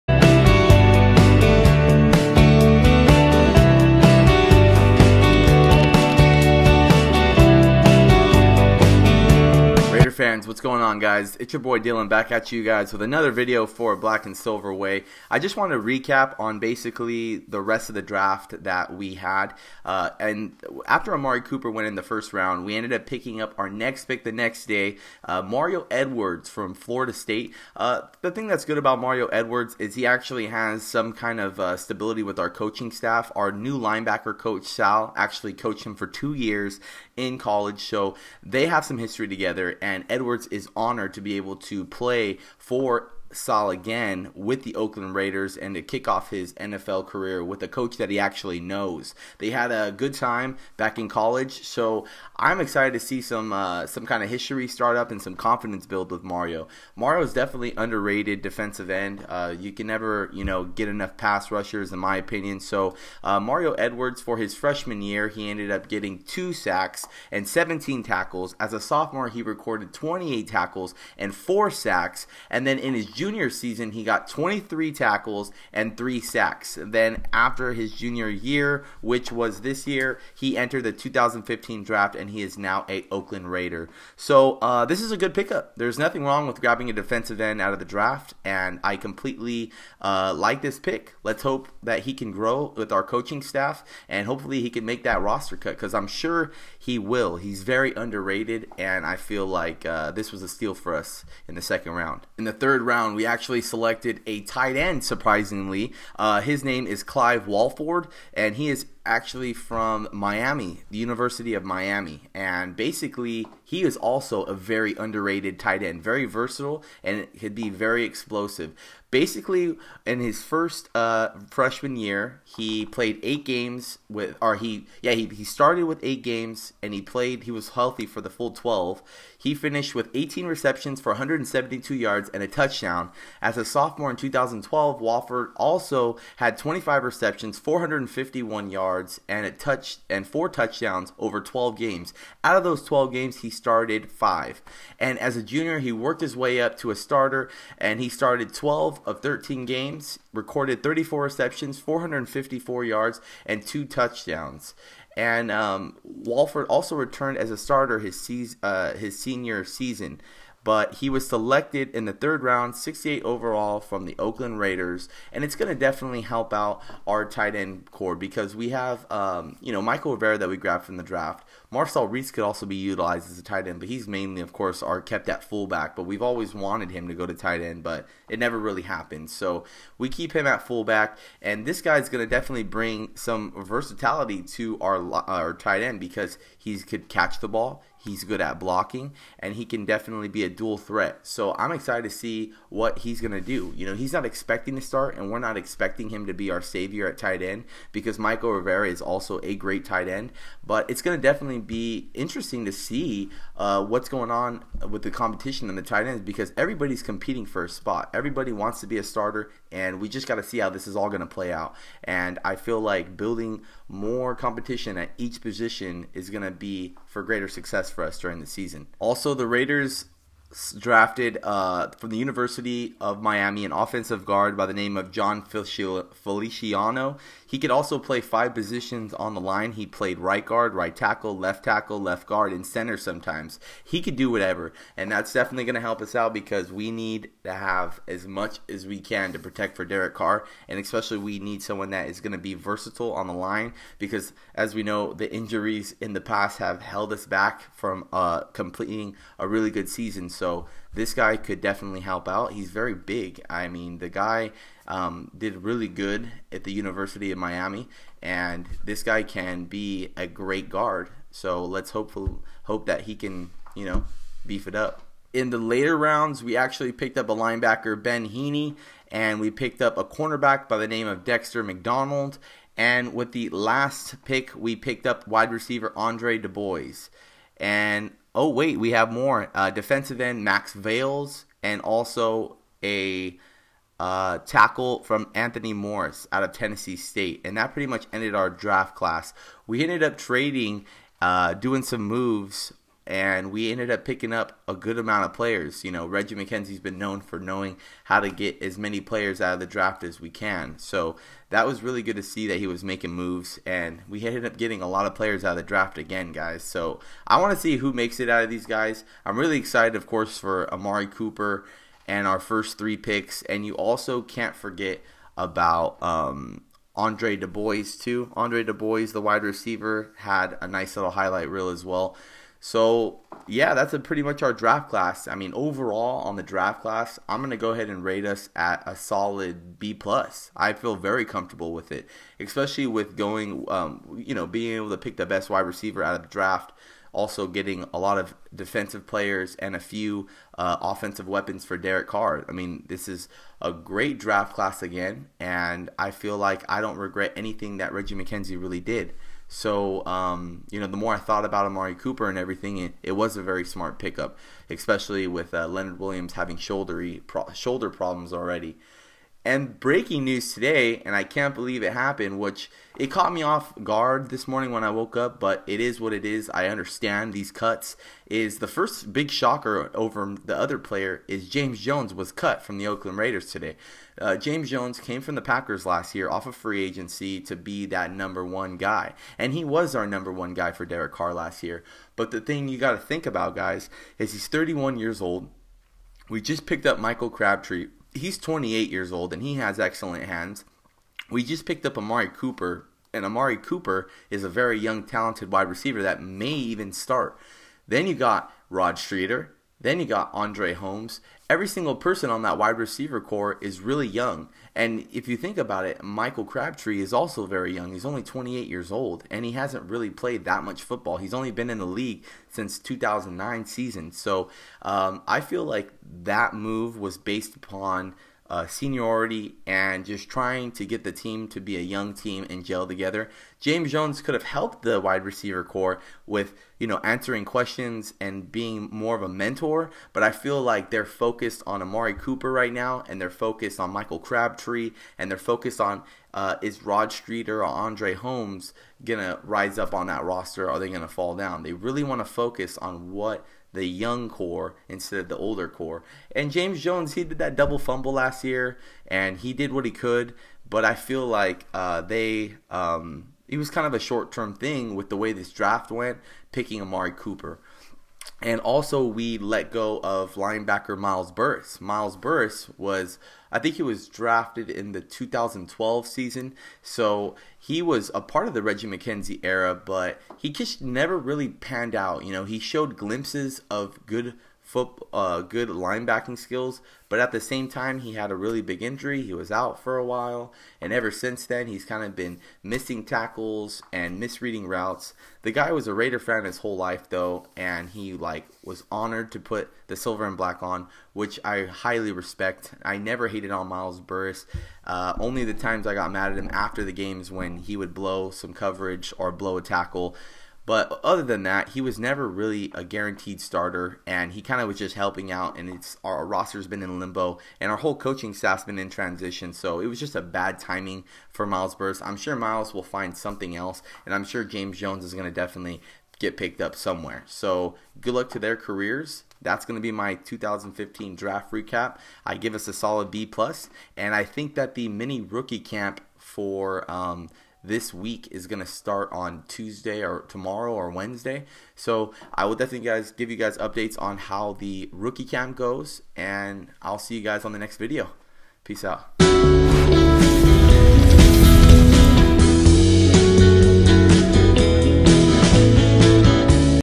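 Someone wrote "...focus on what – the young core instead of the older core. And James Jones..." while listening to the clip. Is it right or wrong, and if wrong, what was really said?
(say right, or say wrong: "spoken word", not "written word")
right.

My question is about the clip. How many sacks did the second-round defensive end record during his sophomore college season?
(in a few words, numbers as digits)
4.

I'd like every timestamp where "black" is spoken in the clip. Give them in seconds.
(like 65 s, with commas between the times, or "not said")
13 s, 490 s.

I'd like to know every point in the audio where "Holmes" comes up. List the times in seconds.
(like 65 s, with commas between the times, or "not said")
400 s, 438 s.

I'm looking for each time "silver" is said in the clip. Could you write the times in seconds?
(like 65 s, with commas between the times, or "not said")
14 s, 489 s.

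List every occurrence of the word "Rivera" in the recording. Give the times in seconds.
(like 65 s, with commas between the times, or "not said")
170 s, 198 s.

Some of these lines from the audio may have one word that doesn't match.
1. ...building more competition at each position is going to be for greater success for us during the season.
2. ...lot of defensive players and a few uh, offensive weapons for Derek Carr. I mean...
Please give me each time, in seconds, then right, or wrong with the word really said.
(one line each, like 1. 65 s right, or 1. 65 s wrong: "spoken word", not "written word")
1. 213 s right
2. 337 s right.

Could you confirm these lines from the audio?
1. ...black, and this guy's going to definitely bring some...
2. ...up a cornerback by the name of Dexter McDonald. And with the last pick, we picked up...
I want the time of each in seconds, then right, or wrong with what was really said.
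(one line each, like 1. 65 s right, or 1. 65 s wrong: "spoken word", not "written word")
1. 180 s wrong: "fullback", not "black"
2. 269 s right.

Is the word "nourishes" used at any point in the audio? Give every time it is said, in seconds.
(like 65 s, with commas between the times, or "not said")
not said.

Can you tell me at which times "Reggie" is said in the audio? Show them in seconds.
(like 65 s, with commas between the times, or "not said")
296 s, 347 s, 468 s.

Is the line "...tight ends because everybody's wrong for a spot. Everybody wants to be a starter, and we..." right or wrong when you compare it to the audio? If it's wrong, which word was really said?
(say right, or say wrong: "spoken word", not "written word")
wrong: "competing", not "wrong".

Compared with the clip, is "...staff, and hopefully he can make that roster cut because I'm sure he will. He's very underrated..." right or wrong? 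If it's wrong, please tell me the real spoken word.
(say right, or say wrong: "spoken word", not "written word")
right.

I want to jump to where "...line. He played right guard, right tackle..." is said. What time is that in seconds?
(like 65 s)
229 s.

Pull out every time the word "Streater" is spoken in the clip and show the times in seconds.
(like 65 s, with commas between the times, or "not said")
398 s, 437 s.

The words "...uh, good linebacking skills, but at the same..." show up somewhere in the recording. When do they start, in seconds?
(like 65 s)
475 s.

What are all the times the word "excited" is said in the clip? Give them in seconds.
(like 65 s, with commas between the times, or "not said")
52 s, 191 s, 309 s.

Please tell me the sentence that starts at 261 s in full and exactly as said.
So let's hopeful hope that he can, you know, beef it up.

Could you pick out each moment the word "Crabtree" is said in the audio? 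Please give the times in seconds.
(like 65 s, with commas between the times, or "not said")
387 s, 406 s, 434 s.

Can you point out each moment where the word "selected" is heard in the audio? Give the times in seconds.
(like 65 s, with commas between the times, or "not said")
103 s, 161 s.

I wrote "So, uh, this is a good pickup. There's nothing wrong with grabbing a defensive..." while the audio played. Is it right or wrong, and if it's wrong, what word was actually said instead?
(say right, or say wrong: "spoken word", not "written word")
right.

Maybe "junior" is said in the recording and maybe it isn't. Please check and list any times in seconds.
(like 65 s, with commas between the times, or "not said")
73 s, 77 s, 145 s.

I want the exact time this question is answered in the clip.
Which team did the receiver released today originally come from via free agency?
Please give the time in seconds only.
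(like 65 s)
375 s.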